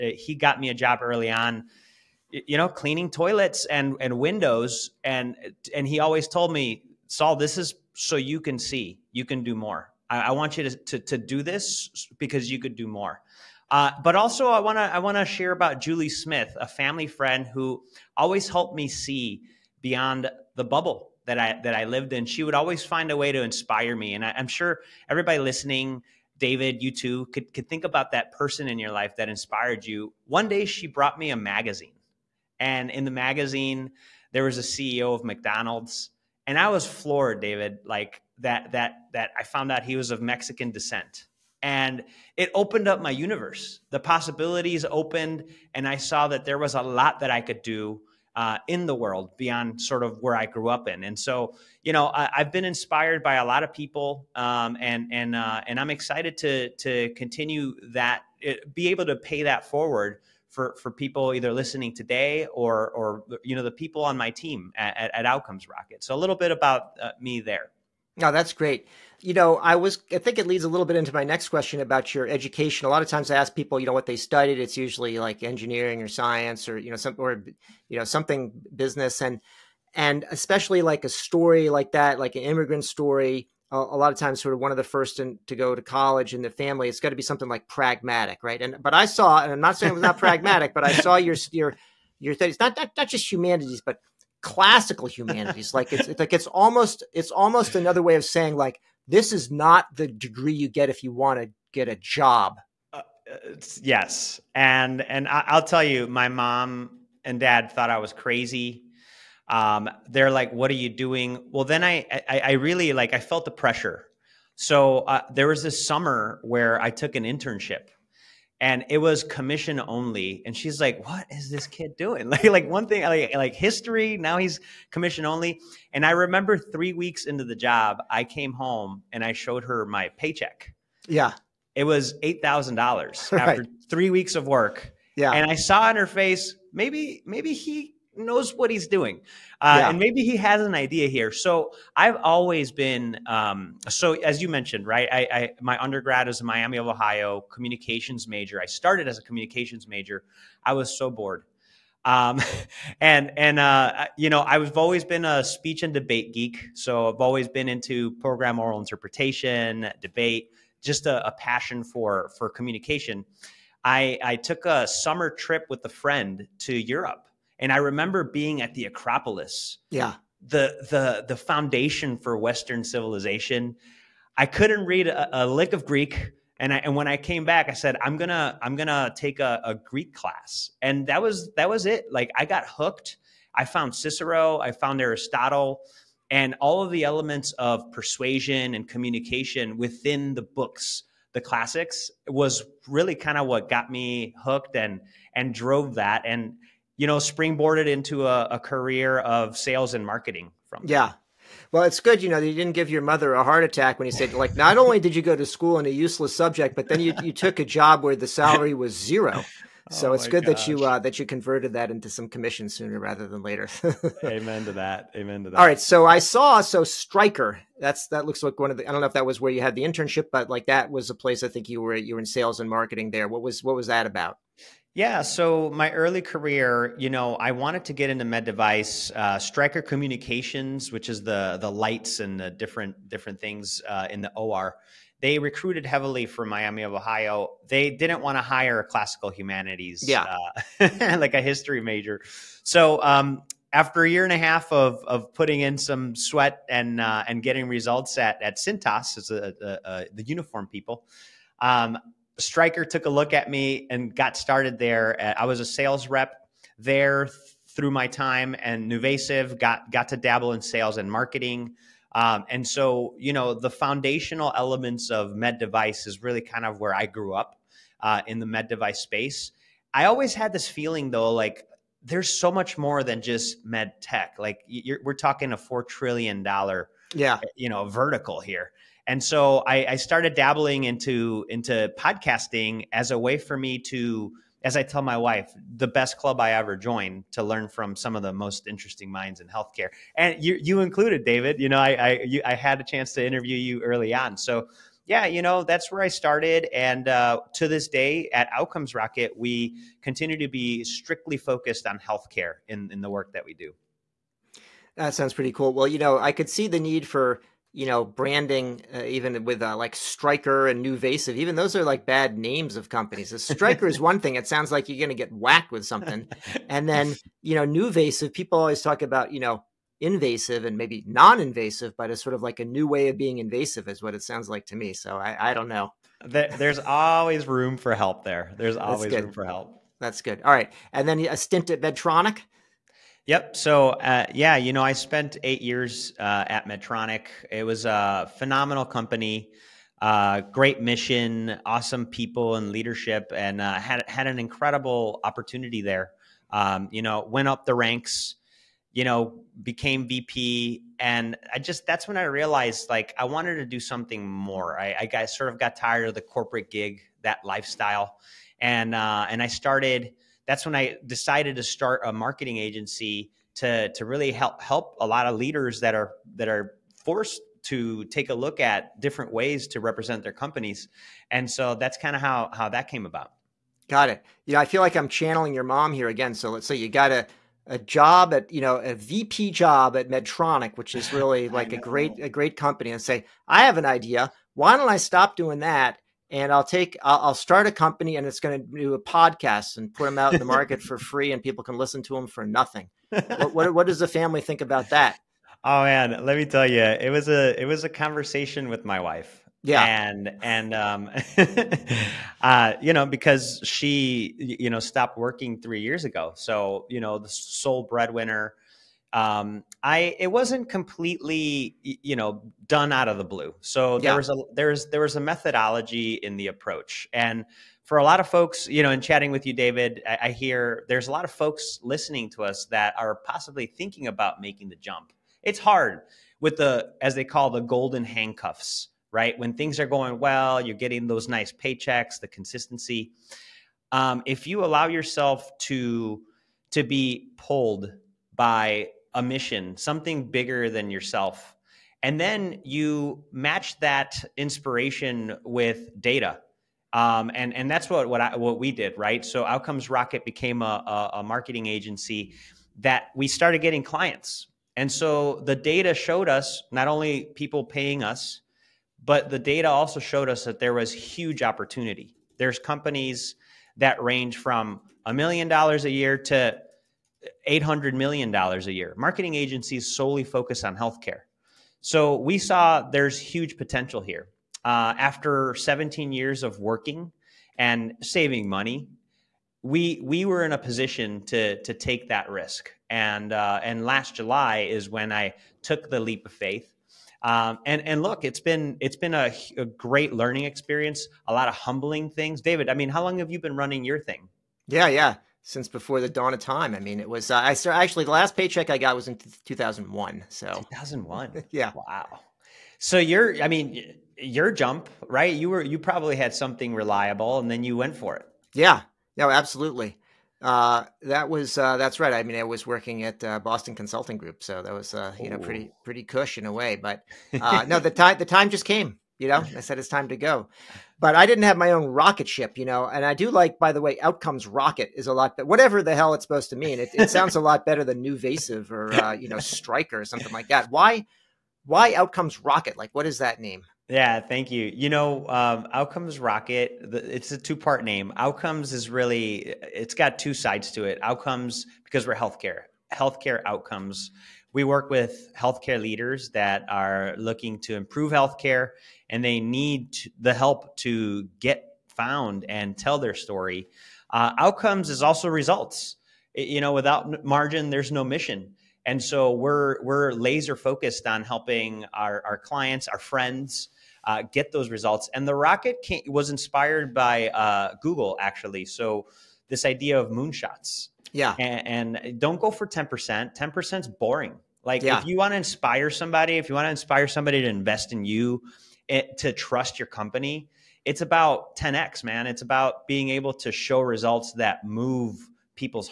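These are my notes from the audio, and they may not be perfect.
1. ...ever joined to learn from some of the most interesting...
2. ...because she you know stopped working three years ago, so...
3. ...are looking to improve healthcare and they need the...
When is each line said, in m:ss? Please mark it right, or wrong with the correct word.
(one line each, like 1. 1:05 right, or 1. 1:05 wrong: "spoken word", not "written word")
1. 4:46 right
2. 6:43 right
3. 9:06 right.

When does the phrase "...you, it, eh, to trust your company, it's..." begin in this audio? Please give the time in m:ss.
9:38.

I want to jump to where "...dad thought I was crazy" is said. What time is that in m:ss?
1:47.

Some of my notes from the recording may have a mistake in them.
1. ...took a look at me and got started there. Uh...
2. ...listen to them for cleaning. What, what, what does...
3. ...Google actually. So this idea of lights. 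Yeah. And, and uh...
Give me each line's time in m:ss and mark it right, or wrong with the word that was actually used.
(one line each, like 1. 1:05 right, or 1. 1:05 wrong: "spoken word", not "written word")
1. 4:12 right
2. 6:31 wrong: "nothing", not "cleaning"
3. 9:27 wrong: "moonshots", not "lights".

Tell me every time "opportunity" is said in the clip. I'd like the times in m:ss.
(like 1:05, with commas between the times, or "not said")
5:45, 7:41.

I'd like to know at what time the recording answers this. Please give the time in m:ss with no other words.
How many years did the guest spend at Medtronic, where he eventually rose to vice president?
5:35.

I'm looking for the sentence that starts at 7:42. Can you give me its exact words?
There's companies that range from a million dollars a year to $800 million a year.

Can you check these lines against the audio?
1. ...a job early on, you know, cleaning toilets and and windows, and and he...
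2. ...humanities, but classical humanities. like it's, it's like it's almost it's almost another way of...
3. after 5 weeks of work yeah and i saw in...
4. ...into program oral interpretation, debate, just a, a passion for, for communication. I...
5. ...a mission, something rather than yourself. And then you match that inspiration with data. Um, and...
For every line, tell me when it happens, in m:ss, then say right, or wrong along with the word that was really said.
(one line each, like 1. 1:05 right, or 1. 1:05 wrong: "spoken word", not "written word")
1. 0:00 right
2. 1:33 right
3. 2:13 wrong: "3", not "5"
4. 2:37 right
5. 7:19 wrong: "bigger", not "rather".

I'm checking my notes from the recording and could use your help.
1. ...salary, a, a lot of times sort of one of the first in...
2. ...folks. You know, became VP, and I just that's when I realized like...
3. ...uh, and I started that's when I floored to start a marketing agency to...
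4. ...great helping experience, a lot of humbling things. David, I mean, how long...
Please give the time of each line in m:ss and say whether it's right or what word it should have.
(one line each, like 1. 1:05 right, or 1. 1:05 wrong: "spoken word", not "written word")
1. 1:22 wrong: "story", not "salary"
2. 5:47 wrong: "ranks", not "folks"
3. 5:58 wrong: "decided", not "floored"
4. 8:09 wrong: "learning", not "helping".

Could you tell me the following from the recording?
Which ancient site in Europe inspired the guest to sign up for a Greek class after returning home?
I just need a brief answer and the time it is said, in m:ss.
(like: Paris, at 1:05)
Acropolis, at 2:48.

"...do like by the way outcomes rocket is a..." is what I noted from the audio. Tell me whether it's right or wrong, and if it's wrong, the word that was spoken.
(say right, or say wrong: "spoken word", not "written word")
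right.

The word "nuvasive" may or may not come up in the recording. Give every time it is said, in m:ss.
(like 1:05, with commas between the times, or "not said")
4:18, 5:10, 5:17, 8:48.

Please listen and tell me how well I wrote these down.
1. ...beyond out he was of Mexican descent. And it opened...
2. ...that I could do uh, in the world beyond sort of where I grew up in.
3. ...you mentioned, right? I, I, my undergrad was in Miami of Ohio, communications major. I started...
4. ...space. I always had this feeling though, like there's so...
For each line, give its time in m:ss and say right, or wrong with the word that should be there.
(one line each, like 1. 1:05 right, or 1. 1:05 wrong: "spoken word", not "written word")
1. 0:39 wrong: "found", not "beyond"
2. 0:47 right
3. 2:24 right
4. 4:28 right.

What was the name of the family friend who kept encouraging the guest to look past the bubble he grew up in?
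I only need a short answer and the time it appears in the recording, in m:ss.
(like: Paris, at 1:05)
Julie Smith, at 0:15.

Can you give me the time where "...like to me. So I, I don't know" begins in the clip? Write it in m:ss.
5:24.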